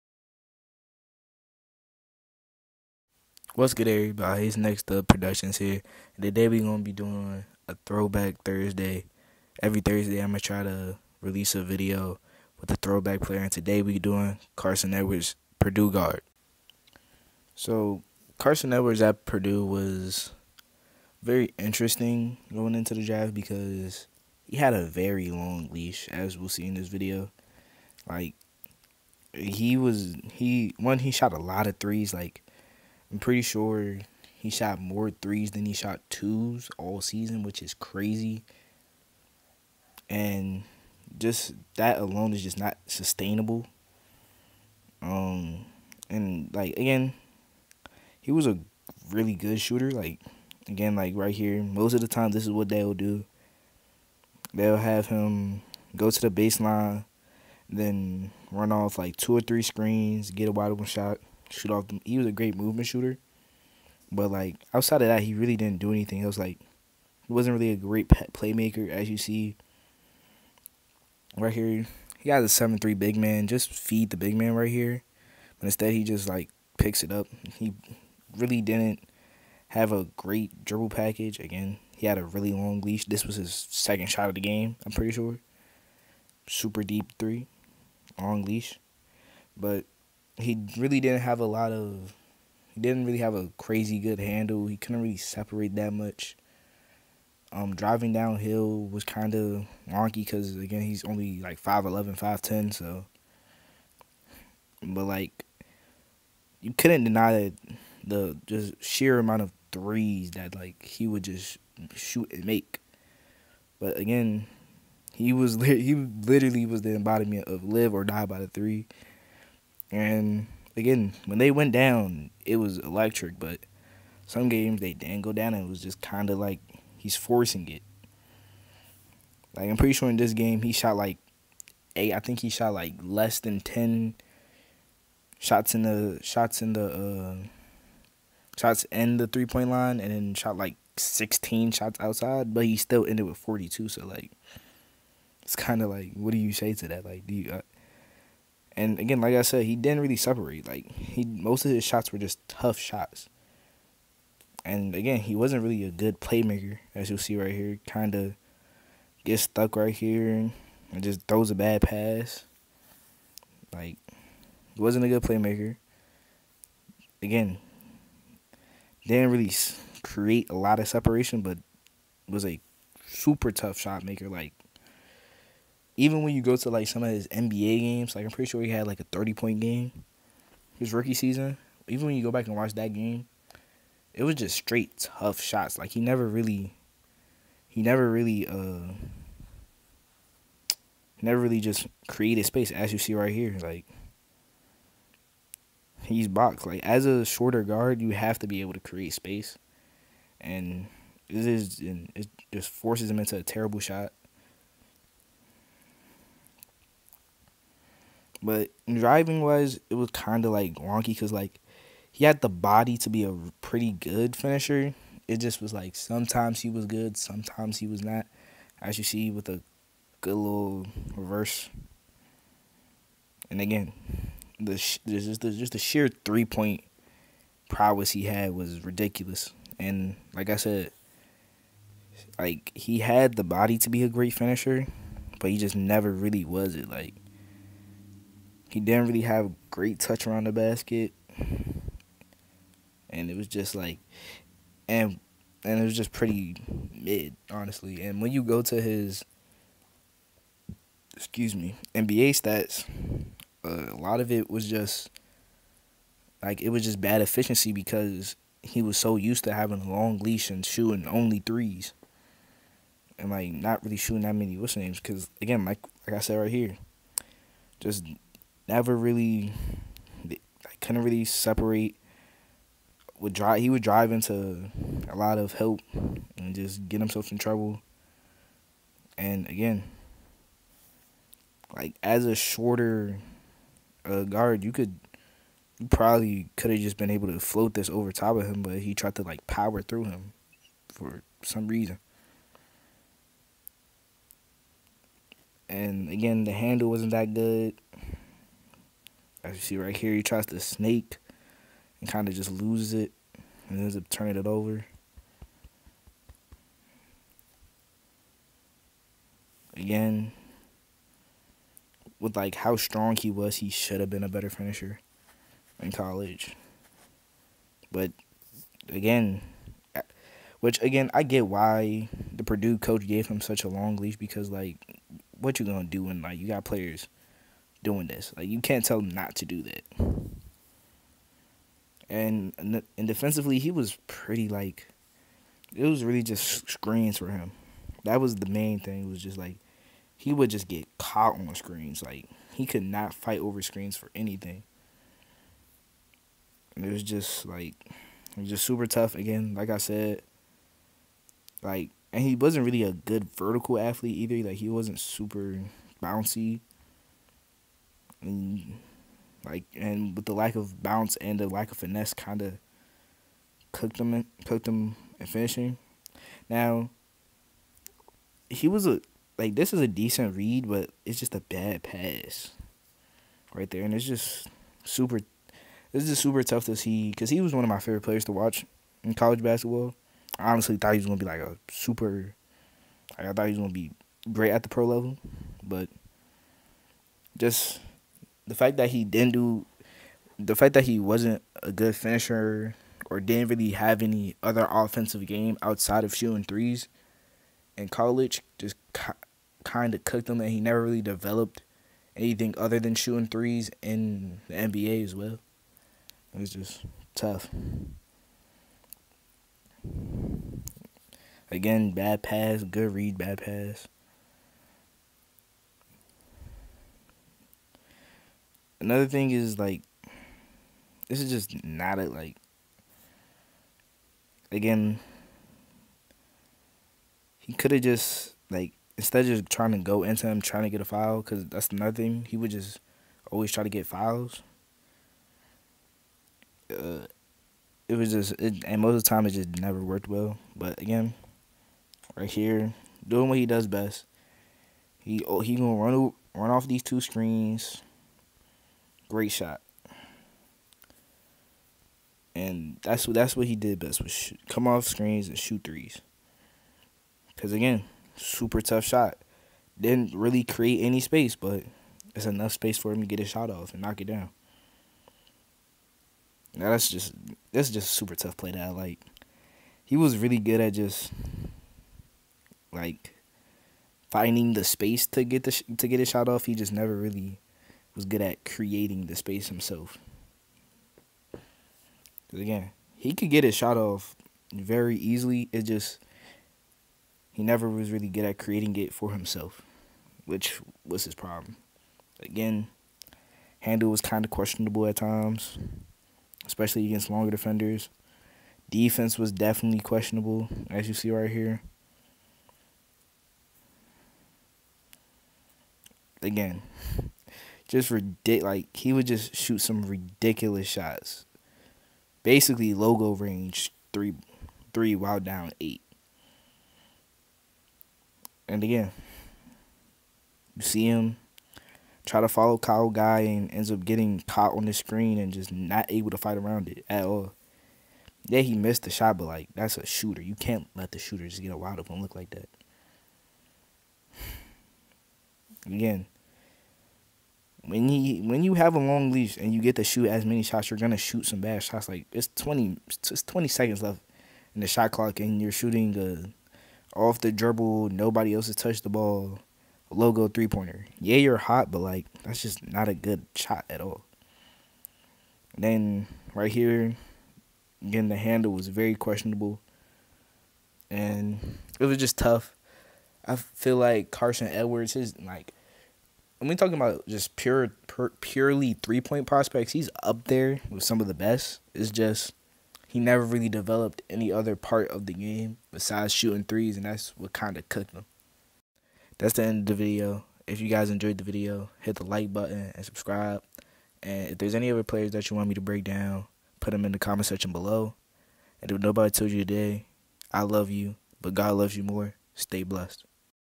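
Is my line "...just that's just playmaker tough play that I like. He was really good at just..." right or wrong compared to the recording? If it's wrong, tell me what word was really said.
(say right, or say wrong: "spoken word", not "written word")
wrong: "super", not "playmaker".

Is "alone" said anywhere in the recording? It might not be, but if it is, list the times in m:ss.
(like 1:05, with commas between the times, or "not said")
0:41.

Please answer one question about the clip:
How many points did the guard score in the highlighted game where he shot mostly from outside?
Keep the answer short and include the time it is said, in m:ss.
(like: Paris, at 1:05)
42, at 2:23.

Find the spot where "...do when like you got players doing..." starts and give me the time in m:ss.
5:25.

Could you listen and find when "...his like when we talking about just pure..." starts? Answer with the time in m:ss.
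9:24.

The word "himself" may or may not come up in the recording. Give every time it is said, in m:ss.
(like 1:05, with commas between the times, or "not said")
4:37, 7:59, 8:09.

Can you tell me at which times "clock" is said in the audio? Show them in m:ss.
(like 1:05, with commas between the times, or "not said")
9:04.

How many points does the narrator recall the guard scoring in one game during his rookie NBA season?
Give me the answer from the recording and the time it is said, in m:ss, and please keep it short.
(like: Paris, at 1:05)
30, at 2:59.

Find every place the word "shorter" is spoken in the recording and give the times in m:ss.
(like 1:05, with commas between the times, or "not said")
3:17, 4:42.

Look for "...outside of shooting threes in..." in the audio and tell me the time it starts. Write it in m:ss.
6:35.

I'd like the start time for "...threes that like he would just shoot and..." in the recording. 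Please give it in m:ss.
1:49.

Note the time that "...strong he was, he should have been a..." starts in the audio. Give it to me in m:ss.
5:12.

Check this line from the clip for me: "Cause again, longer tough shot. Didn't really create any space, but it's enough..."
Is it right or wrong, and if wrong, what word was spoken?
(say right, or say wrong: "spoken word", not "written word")
wrong: "super", not "longer".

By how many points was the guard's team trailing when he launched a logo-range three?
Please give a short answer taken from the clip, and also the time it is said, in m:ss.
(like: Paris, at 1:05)
8, at 8:35.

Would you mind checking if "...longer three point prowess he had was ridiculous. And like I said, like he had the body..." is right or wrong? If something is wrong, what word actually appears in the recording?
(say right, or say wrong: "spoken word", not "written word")
wrong: "sheer", not "longer".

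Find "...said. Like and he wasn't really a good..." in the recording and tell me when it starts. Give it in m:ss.
5:49.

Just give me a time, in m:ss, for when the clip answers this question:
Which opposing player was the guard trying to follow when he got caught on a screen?
8:42.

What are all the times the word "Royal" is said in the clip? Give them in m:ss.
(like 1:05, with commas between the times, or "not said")
not said.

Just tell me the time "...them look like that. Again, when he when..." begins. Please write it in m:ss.
8:51.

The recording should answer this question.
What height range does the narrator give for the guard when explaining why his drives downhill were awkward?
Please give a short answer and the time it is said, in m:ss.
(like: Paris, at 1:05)
5'11", 5'10", at 1:41.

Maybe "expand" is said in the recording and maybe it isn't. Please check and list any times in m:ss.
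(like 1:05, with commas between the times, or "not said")
not said.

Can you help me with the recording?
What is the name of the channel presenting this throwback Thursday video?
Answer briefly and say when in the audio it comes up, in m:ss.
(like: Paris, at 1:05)
Next Up Productions, at 0:04.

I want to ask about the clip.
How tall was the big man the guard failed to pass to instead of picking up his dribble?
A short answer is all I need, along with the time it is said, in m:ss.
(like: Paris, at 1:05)
7'3", at 1:12.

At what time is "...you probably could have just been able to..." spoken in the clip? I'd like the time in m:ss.
4:45.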